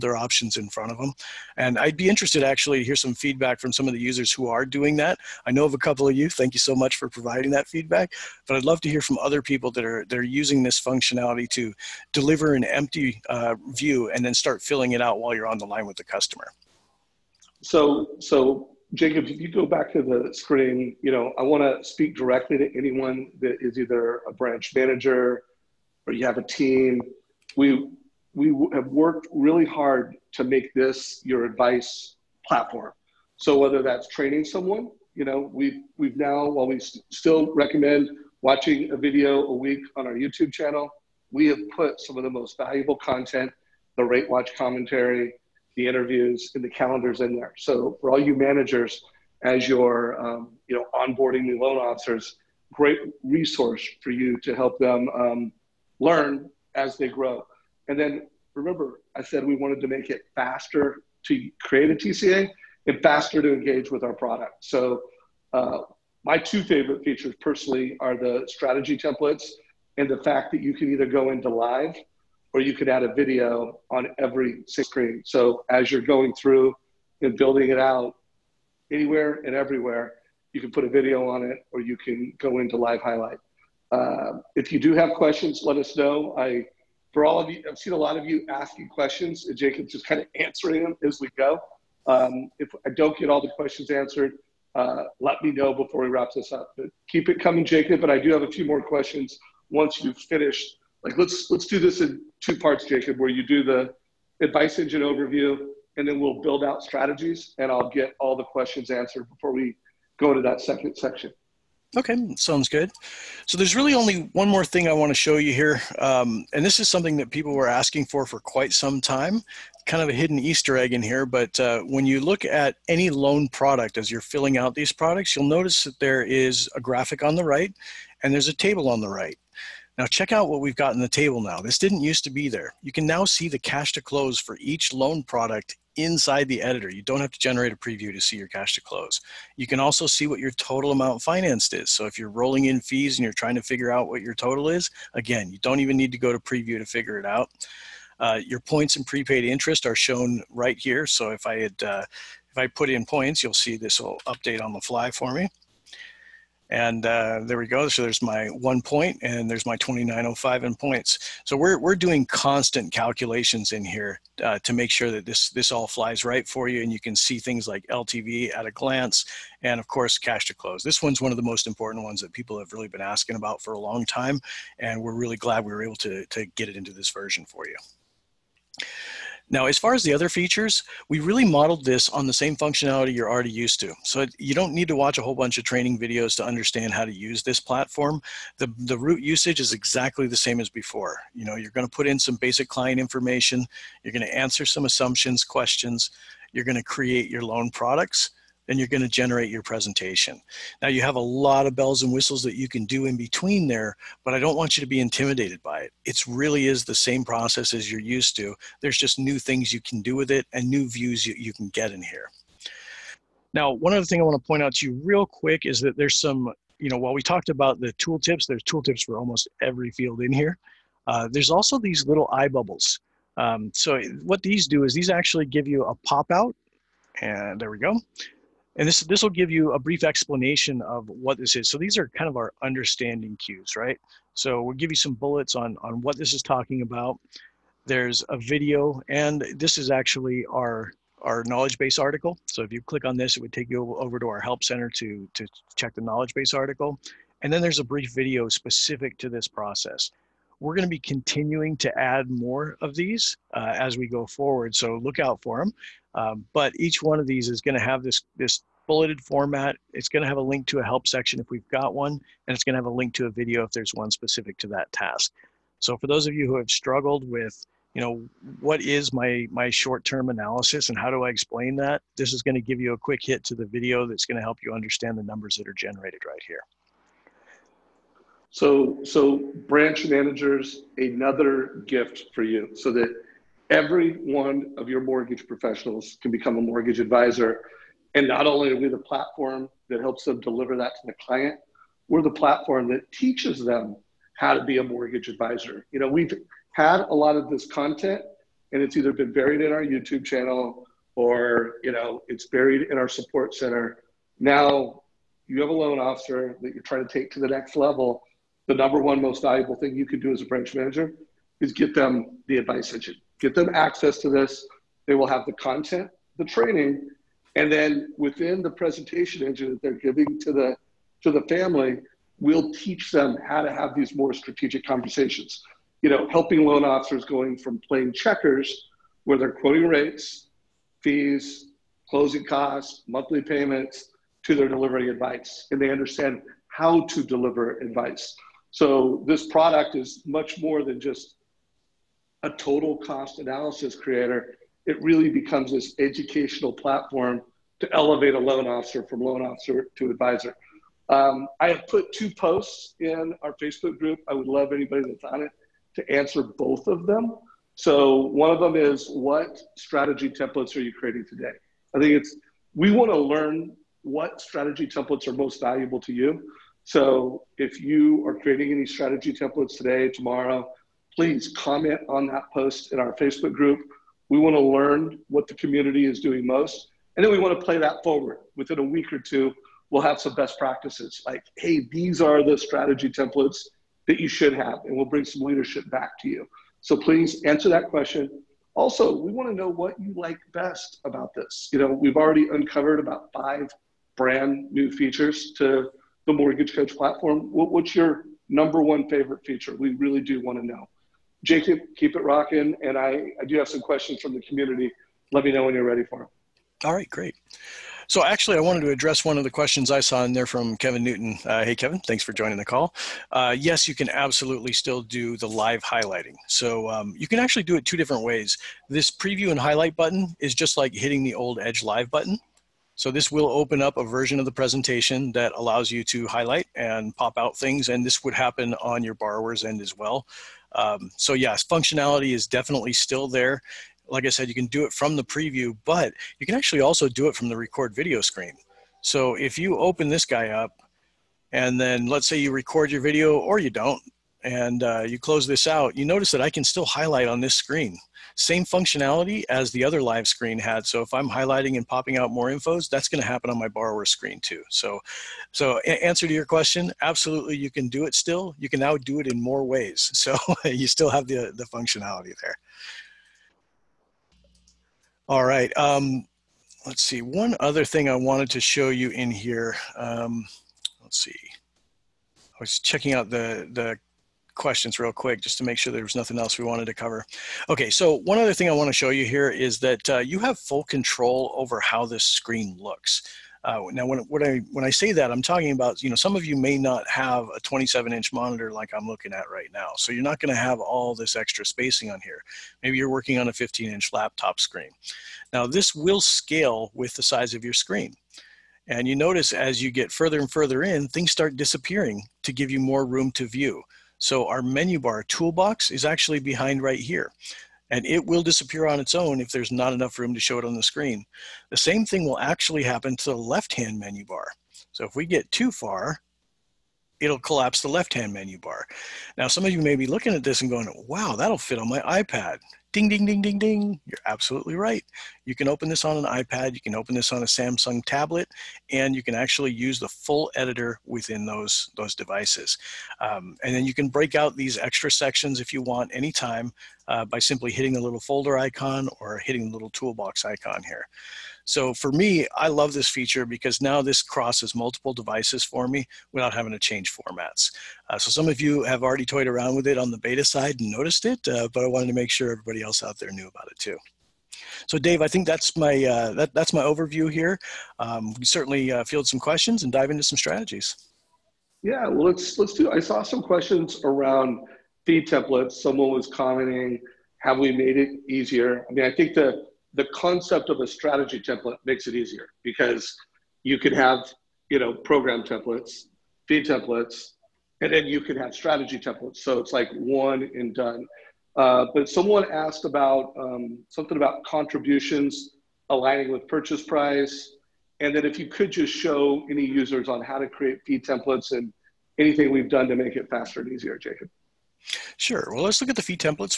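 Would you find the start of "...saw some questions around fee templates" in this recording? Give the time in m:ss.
9:23.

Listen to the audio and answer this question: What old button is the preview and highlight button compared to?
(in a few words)
Edge Live.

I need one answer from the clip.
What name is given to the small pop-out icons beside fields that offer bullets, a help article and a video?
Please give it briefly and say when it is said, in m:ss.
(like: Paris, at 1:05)
eye bubbles, at 3:42.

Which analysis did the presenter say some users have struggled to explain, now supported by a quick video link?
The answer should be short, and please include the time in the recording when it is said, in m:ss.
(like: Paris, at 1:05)
short-term analysis, at 4:29.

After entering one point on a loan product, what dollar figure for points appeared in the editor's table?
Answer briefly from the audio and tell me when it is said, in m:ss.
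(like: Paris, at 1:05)
2905, at 2:39.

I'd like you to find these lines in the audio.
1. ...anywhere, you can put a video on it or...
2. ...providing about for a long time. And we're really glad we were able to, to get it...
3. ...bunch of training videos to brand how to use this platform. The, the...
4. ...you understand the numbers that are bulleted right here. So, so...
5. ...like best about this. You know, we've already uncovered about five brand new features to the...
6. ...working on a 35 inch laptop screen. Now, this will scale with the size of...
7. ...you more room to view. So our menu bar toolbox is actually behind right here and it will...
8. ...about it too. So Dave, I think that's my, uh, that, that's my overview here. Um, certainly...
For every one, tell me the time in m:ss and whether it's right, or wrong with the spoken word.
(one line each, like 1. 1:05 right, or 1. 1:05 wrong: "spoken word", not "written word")
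1. 1:19 wrong: "everywhere", not "anywhere"
2. 2:53 wrong: "asking", not "providing"
3. 3:05 wrong: "understand", not "brand"
4. 4:34 wrong: "generated", not "bulleted"
5. 6:30 right
6. 8:13 wrong: "15", not "35"
7. 8:22 right
8. 9:13 right.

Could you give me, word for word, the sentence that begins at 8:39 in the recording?
Now, some of you may be looking at this and going, wow, that'll fit on my iPad.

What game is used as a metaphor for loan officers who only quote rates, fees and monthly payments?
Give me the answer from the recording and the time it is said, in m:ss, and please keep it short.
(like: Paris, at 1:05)
checkers, at 5:28.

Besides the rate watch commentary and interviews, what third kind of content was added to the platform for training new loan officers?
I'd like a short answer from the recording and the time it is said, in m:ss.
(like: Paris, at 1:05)
calendars, at 0:46.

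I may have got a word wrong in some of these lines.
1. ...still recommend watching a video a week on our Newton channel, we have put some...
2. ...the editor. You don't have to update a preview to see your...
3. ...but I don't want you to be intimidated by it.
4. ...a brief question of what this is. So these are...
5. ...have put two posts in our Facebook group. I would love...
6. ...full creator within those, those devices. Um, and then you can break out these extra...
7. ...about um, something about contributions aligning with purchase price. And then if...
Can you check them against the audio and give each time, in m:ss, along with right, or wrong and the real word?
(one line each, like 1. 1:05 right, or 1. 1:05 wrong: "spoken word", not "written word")
1. 0:37 wrong: "YouTube", not "Newton"
2. 2:16 wrong: "generate", not "update"
3. 3:24 right
4. 3:49 wrong: "explanation", not "question"
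5. 5:51 right
6. 8:50 wrong: "editor", not "creator"
7. 9:42 right.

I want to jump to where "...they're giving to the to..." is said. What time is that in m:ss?
5:19.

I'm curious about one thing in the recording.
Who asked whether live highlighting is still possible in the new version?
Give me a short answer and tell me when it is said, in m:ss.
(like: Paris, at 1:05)
Kevin Newton, at 6:50.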